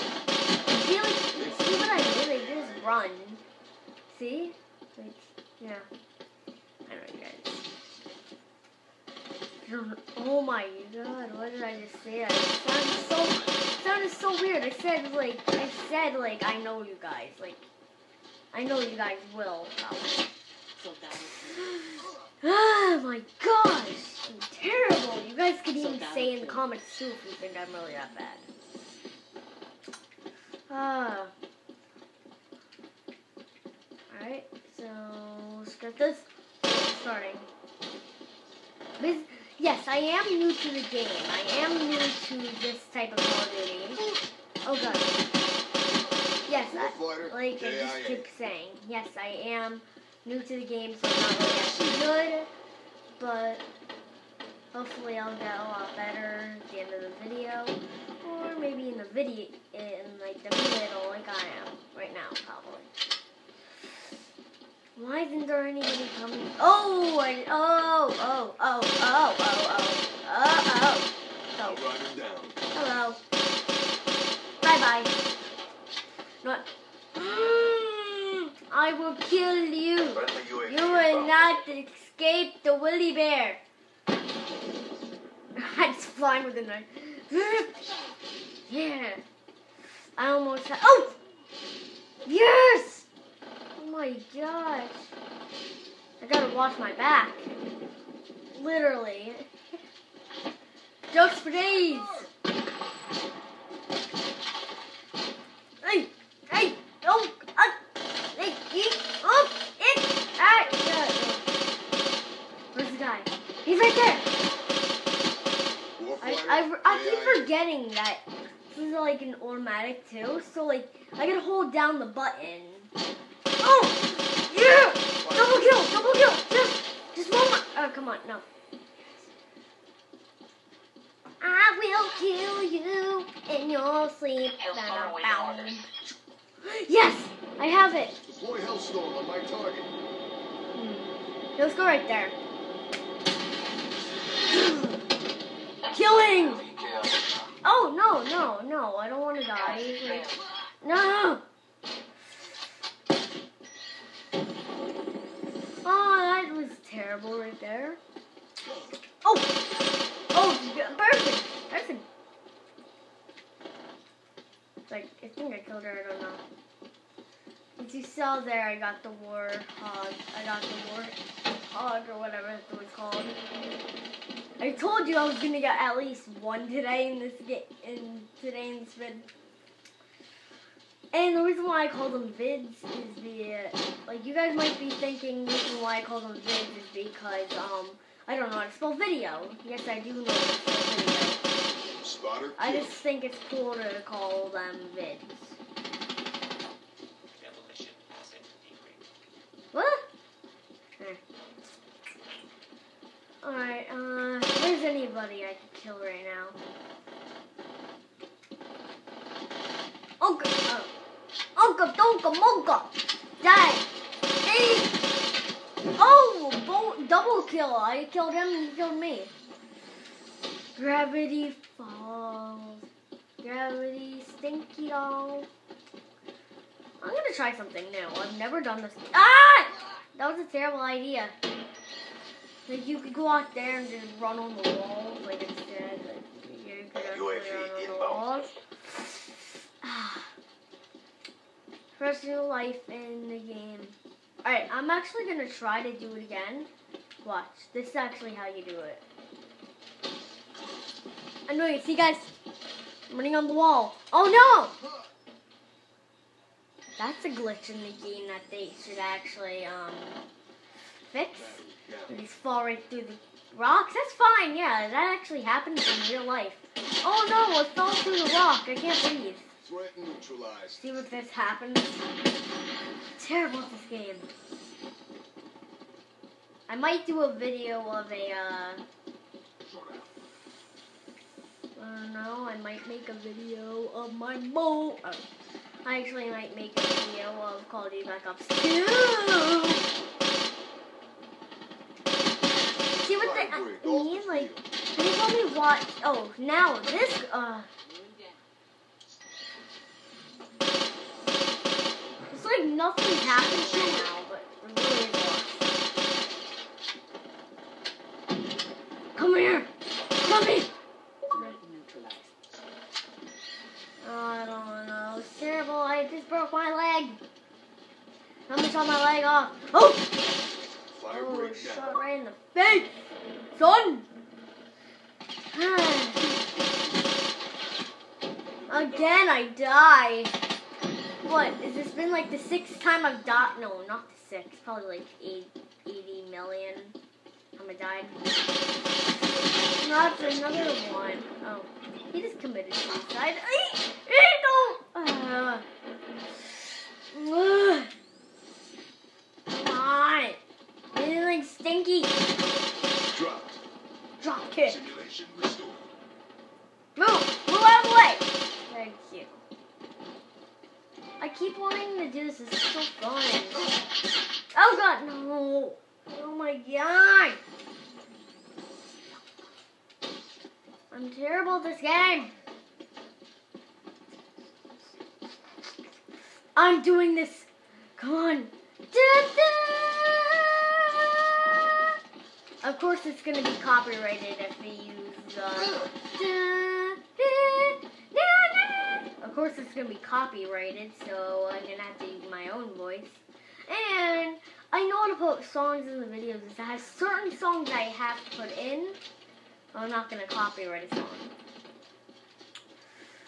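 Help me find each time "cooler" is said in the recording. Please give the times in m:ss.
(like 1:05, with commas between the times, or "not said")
3:13.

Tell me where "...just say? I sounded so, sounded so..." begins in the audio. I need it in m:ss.
0:11.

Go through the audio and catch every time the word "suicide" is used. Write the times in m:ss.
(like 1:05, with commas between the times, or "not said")
5:42.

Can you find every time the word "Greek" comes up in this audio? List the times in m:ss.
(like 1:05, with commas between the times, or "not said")
not said.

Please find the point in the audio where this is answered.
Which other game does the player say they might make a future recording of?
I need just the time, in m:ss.
4:47.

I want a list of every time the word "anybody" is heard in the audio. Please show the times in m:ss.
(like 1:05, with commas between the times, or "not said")
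1:05, 3:24.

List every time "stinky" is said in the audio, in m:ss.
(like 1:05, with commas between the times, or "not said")
3:44, 5:51.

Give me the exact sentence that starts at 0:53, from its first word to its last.
But hopefully I'll get a lot better at the end of the video.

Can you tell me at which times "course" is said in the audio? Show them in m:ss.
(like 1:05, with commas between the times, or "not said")
6:22, 6:29.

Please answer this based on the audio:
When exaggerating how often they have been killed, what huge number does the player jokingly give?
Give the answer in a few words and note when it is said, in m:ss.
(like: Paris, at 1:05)
80 million, at 5:35.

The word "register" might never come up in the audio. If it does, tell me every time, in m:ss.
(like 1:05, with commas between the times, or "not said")
not said.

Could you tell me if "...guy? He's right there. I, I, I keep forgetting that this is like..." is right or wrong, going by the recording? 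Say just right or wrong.
right.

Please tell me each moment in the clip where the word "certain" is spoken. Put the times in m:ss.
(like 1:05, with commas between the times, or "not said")
6:36.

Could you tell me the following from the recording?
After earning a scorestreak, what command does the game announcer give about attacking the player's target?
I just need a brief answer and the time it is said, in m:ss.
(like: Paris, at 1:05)
Deploy Hellstorm, at 2:18.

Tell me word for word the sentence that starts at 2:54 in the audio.
I told you I was gonna get at least one today in this game, in today in this vid.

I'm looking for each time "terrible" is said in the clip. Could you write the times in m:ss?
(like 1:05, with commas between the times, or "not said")
0:24, 3:50, 4:33, 5:15, 6:11.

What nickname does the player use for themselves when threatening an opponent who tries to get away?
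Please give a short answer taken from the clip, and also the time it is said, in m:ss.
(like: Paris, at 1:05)
the Willy Bear, at 1:22.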